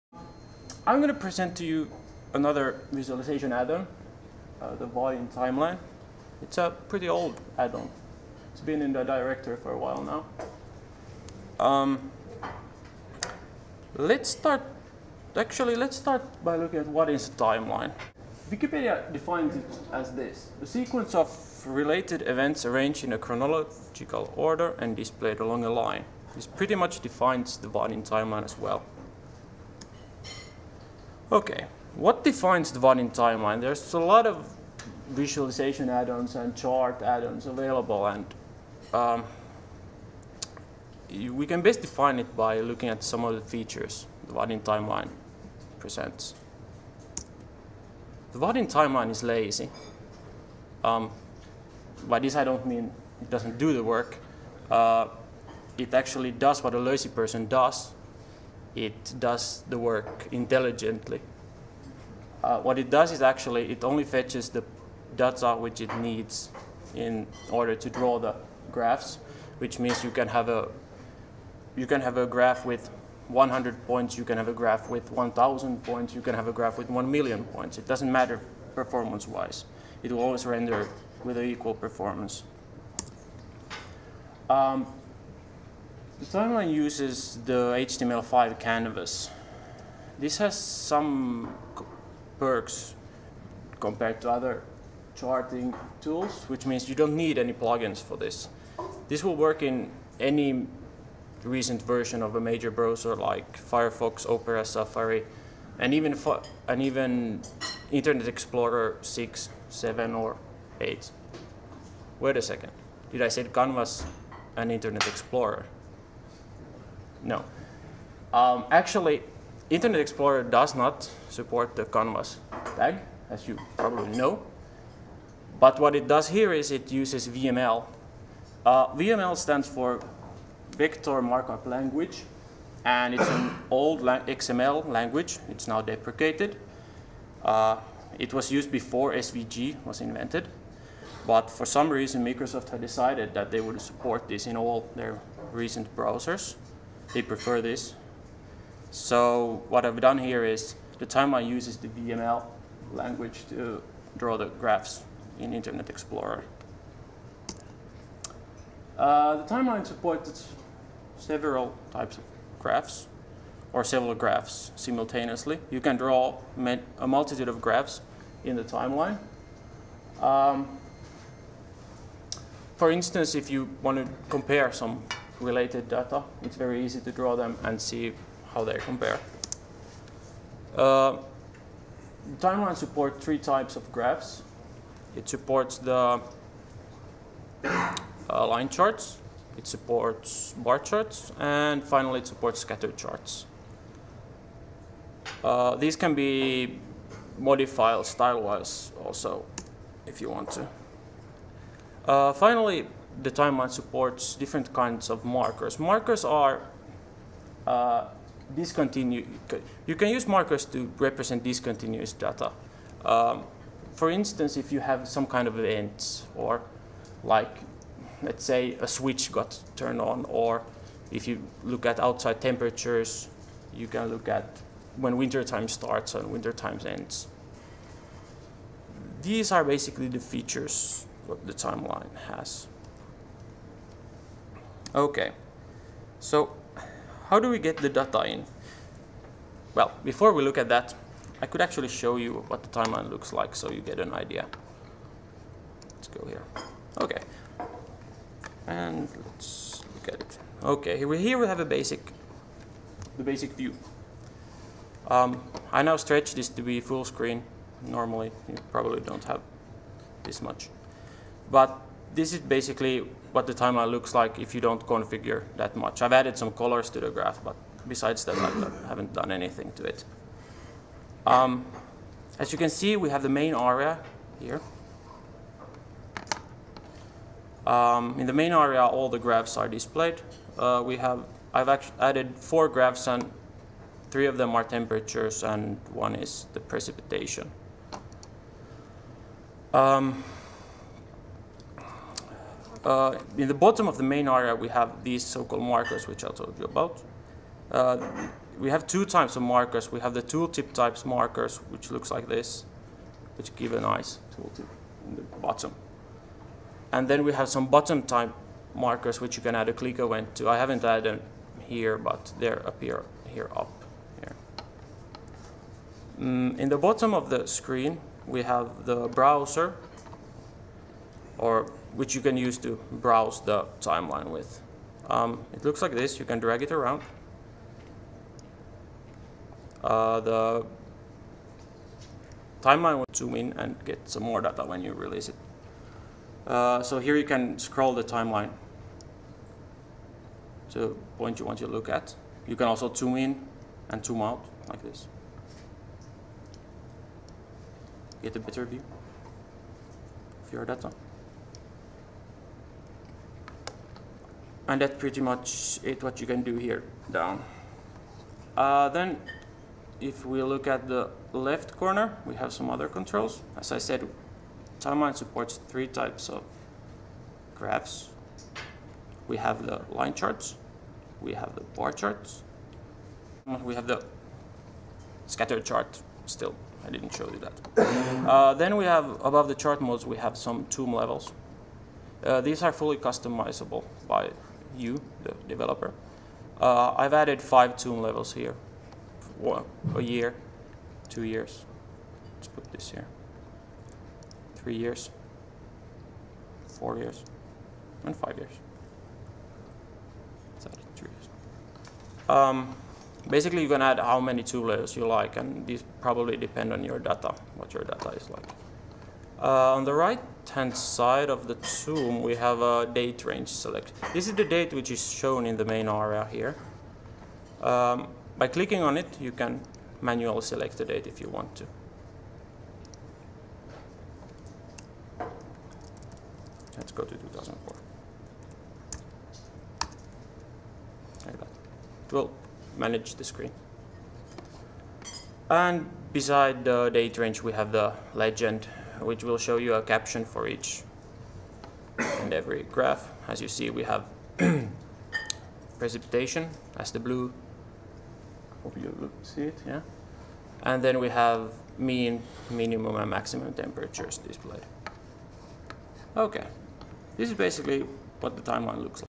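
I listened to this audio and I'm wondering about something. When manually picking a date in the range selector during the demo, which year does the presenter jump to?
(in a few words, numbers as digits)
2004.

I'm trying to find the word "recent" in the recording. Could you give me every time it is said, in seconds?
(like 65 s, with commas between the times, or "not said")
101 s, 145 s.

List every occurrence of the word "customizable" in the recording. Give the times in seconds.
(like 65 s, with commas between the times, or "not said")
382 s.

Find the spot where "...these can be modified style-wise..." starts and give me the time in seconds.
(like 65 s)
195 s.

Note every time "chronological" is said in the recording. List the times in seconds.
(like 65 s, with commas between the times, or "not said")
23 s.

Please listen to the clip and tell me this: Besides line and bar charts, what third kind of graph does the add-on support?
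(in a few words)
scatter charts.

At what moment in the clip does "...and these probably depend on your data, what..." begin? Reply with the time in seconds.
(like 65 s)
405 s.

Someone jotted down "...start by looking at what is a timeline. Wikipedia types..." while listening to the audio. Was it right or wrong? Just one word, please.
wrong.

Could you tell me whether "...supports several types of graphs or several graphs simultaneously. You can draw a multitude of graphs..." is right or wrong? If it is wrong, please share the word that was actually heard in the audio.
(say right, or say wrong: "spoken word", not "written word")
right.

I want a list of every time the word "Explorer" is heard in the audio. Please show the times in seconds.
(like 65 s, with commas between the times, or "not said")
108 s, 115 s, 120 s, 155 s.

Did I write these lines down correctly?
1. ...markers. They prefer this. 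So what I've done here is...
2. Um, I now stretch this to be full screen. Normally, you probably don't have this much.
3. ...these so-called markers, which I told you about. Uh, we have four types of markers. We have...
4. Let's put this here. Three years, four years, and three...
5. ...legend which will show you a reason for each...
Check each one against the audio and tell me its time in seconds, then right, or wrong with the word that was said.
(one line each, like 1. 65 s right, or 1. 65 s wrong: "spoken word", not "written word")
1. 145 s wrong: "browsers", not "markers"
2. 255 s right
3. 295 s wrong: "two", not "four"
4. 392 s wrong: "five", not "three"
5. 438 s wrong: "caption", not "reason".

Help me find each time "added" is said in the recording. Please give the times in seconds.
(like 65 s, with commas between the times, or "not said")
266 s, 281 s, 310 s, 387 s.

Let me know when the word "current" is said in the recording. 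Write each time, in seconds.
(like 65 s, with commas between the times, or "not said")
not said.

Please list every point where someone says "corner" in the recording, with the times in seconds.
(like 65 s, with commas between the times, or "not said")
361 s.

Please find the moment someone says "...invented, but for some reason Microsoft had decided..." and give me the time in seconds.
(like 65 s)
140 s.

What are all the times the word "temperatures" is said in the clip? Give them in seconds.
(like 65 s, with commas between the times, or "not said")
222 s, 284 s, 453 s.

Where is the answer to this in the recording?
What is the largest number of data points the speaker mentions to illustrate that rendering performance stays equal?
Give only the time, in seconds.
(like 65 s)
76 s.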